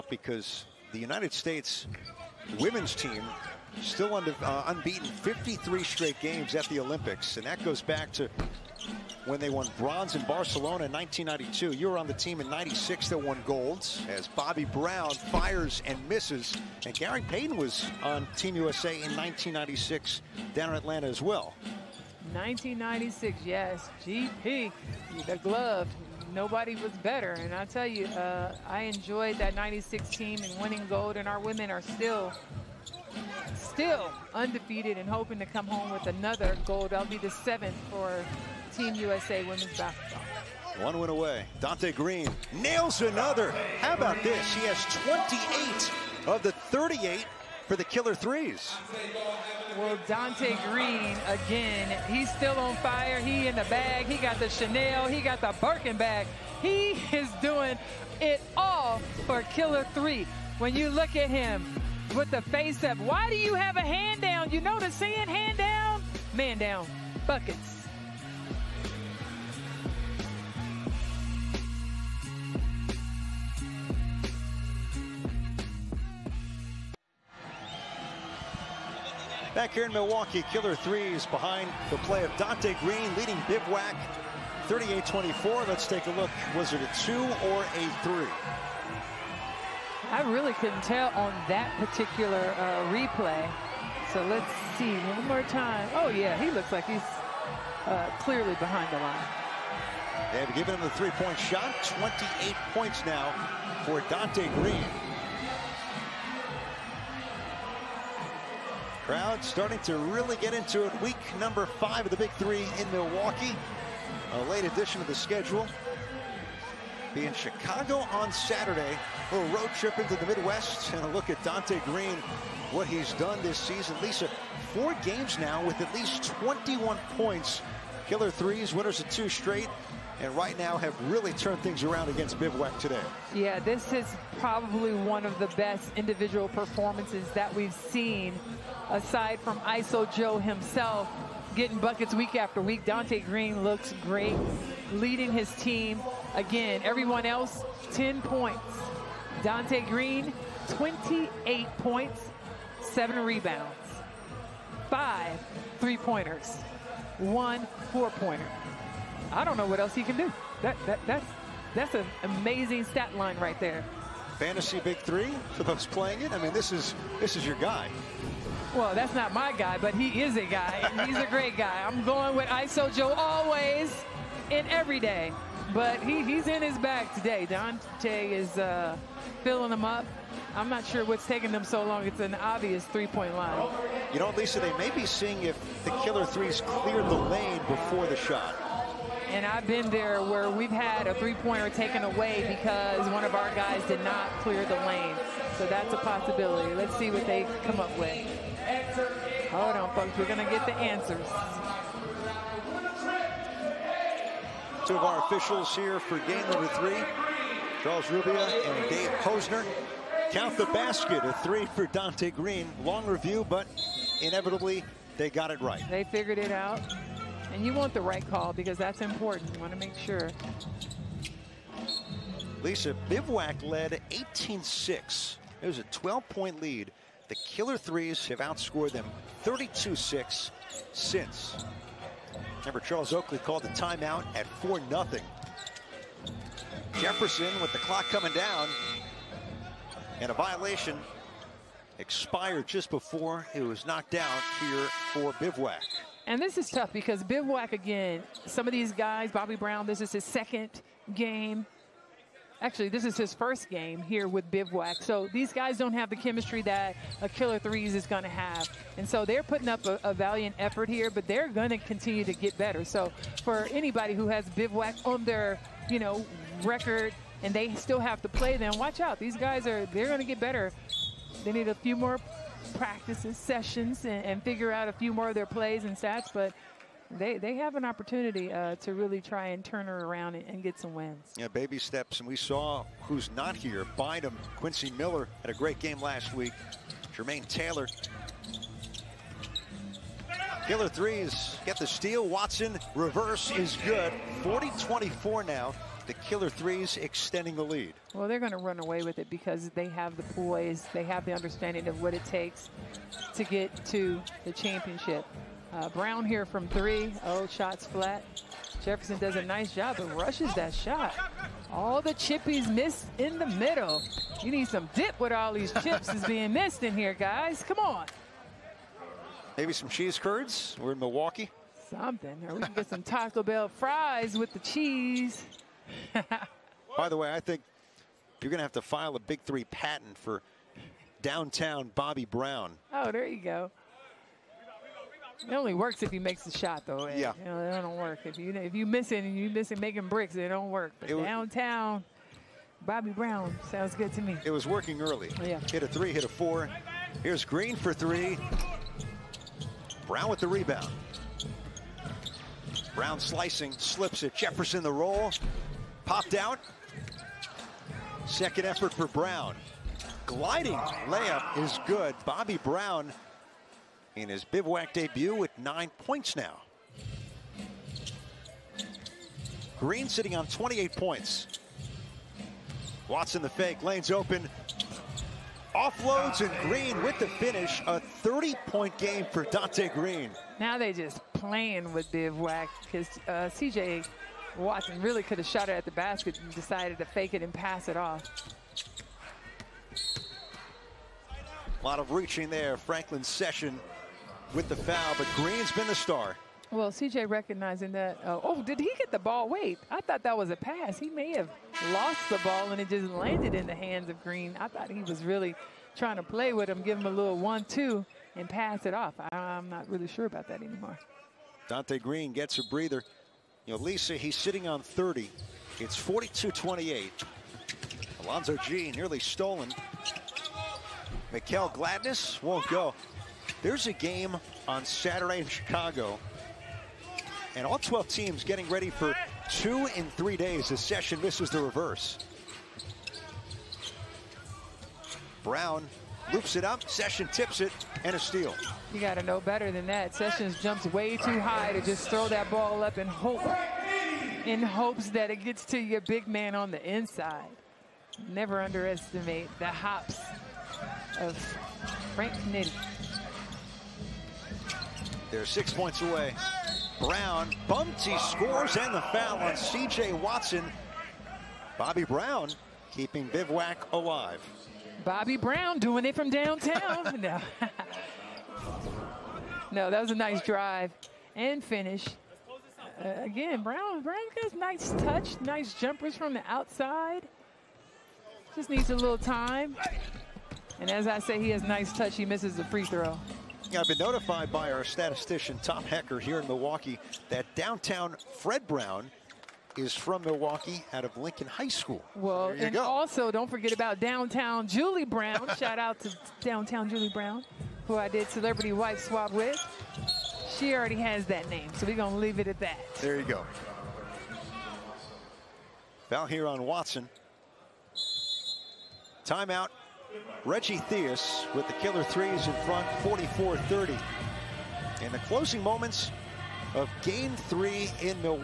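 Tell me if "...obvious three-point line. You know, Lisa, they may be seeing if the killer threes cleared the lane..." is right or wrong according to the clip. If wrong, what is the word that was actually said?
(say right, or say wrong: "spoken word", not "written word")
right.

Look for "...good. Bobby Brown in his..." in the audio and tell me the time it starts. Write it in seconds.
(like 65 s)
361 s.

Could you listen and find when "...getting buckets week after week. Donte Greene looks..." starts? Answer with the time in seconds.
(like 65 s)
141 s.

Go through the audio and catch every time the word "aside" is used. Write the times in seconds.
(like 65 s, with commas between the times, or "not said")
138 s.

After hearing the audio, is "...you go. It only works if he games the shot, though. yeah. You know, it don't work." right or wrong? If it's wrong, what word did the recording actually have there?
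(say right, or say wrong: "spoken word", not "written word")
wrong: "makes", not "games".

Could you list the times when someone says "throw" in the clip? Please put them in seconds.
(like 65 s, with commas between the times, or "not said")
442 s, 482 s.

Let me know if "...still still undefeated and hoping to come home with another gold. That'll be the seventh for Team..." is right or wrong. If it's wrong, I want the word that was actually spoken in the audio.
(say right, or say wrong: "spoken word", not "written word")
right.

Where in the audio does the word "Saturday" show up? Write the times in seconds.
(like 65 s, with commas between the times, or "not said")
118 s, 424 s.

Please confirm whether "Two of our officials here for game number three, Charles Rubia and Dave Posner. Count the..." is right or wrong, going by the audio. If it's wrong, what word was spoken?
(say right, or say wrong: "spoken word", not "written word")
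right.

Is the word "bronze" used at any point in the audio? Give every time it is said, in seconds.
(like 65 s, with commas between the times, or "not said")
9 s.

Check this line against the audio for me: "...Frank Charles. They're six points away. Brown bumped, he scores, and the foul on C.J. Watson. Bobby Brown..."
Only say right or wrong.
wrong.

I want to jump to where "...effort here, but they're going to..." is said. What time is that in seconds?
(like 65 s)
260 s.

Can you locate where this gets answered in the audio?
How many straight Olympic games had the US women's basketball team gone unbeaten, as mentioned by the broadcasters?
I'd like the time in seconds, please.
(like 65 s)
5 s.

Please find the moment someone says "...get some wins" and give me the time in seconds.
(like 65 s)
280 s.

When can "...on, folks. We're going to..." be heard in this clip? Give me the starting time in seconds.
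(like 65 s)
199 s.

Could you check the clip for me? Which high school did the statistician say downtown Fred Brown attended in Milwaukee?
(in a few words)
Lincoln High School.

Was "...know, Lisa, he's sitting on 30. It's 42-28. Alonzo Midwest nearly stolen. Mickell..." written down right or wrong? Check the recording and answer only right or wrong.
wrong.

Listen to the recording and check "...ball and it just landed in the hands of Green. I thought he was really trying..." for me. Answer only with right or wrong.
right.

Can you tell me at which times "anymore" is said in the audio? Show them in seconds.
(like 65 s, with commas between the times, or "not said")
410 s.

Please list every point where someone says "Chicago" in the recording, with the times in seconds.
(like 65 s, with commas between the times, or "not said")
117 s, 425 s.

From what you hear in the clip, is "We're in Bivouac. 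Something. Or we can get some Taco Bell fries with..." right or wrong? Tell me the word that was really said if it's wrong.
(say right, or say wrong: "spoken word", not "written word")
wrong: "Milwaukee", not "Bivouac".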